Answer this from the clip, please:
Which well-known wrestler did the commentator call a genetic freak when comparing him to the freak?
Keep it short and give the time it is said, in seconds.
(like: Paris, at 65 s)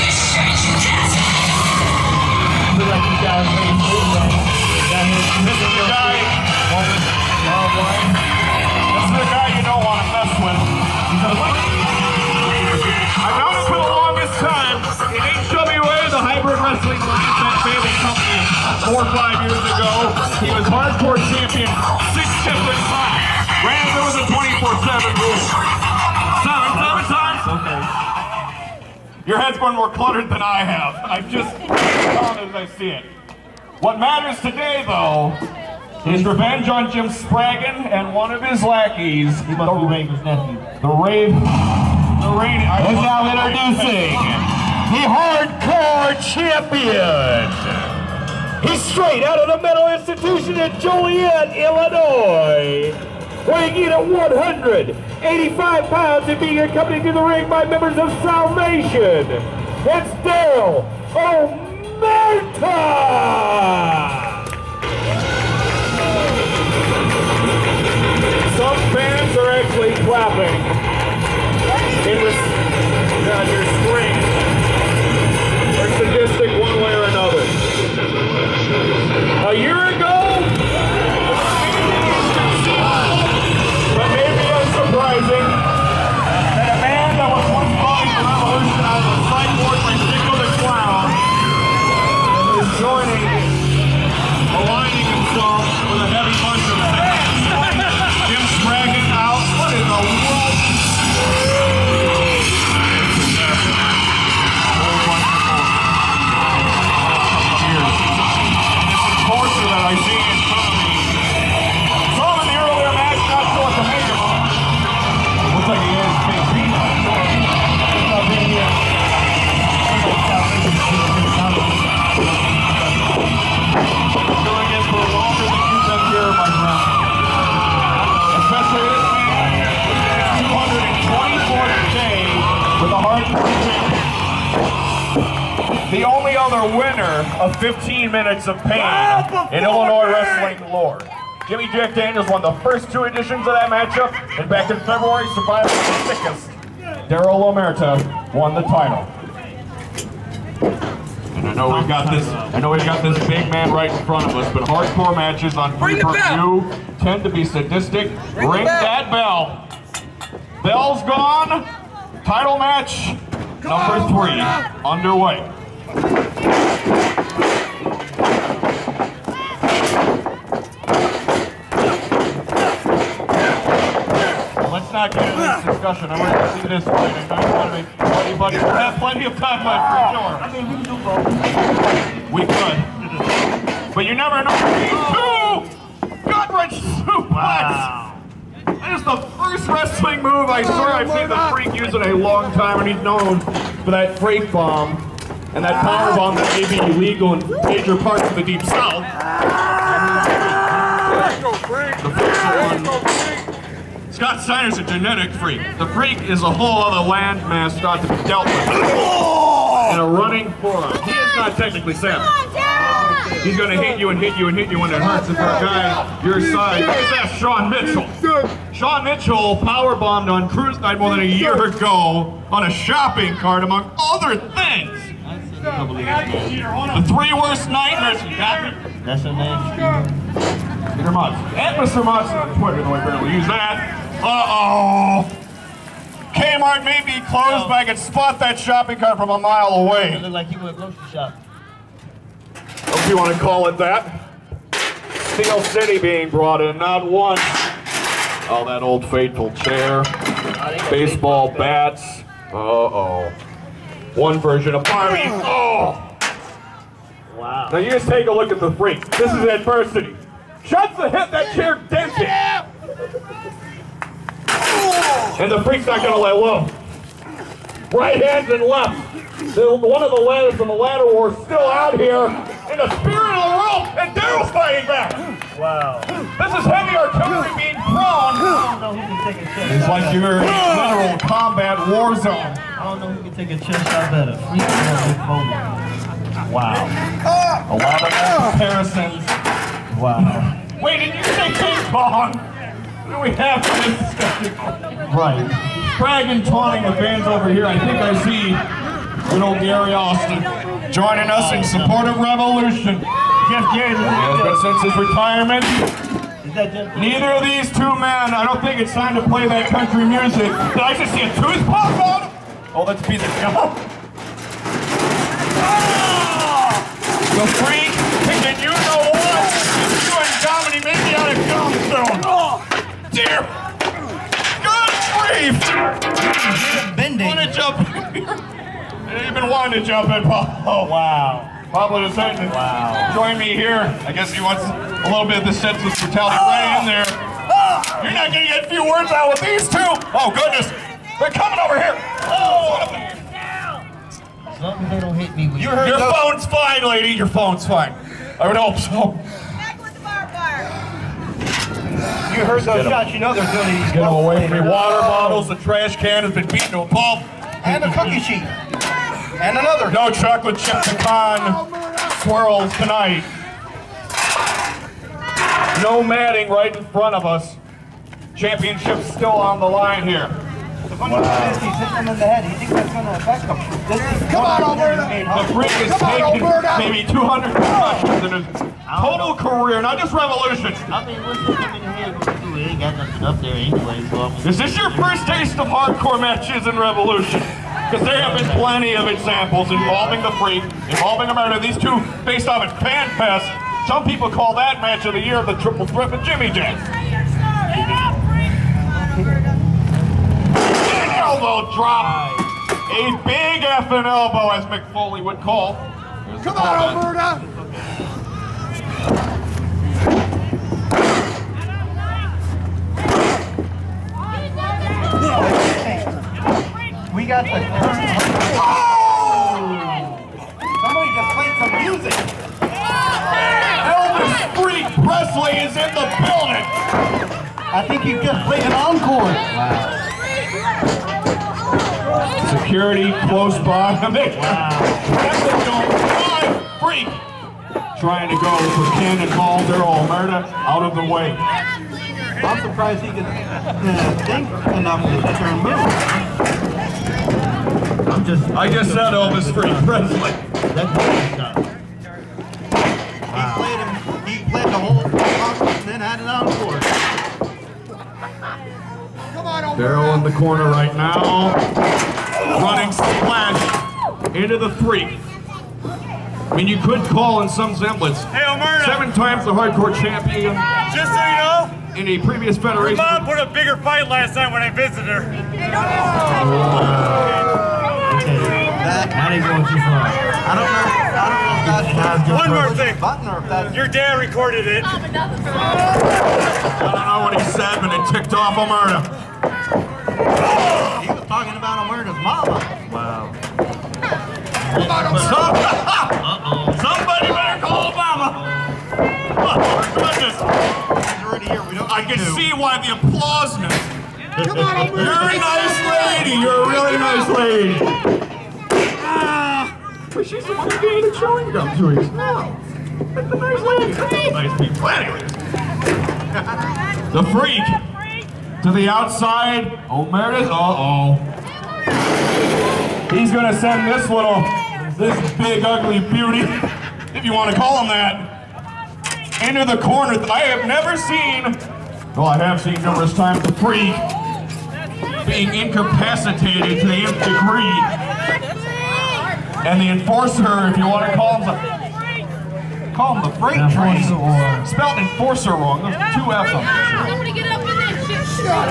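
Scott Steiner, at 204 s.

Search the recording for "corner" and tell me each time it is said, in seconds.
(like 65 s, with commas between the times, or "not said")
460 s, 529 s.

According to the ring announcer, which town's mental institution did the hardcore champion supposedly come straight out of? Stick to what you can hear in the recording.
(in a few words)
Joliet, Illinois.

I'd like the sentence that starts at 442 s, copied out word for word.
I'm surprised he could uh, think enough to turn move.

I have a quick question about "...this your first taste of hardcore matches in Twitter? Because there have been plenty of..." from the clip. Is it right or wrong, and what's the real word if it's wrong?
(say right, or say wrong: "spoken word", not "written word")
wrong: "Revolution", not "Twitter".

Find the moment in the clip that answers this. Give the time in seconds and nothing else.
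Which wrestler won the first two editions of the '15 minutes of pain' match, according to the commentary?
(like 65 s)
141 s.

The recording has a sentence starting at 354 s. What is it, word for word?
Water bottles, the trash can has been beaten to a pulp.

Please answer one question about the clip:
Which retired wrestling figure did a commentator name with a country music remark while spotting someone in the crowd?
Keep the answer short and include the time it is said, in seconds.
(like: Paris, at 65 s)
Jeff Jarrett, at 303 s.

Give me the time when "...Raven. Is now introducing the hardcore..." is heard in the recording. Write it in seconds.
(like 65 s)
42 s.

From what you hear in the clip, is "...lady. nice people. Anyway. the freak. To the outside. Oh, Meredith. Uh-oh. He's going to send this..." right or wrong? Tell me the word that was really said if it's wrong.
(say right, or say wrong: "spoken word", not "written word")
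right.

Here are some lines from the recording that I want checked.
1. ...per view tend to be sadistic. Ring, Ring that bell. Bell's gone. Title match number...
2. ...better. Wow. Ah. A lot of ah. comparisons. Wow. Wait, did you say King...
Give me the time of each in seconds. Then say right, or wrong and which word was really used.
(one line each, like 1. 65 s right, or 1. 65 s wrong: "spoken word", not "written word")
1. 155 s right
2. 284 s right.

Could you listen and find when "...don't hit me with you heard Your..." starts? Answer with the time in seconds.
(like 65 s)
344 s.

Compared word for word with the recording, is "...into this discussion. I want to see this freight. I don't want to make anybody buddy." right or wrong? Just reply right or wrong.
wrong.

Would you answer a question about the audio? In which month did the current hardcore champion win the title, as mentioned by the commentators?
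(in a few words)
February.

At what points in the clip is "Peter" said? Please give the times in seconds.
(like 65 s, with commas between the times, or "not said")
230 s, 313 s.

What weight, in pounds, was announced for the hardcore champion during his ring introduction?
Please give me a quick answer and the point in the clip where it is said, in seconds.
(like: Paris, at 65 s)
185, at 54 s.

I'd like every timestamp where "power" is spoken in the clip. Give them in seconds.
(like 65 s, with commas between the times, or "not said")
195 s, 219 s.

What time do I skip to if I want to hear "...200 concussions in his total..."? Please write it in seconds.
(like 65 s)
377 s.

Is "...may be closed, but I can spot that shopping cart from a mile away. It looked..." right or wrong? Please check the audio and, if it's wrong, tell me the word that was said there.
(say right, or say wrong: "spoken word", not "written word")
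right.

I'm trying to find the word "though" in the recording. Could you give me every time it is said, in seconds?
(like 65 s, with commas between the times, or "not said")
34 s, 232 s.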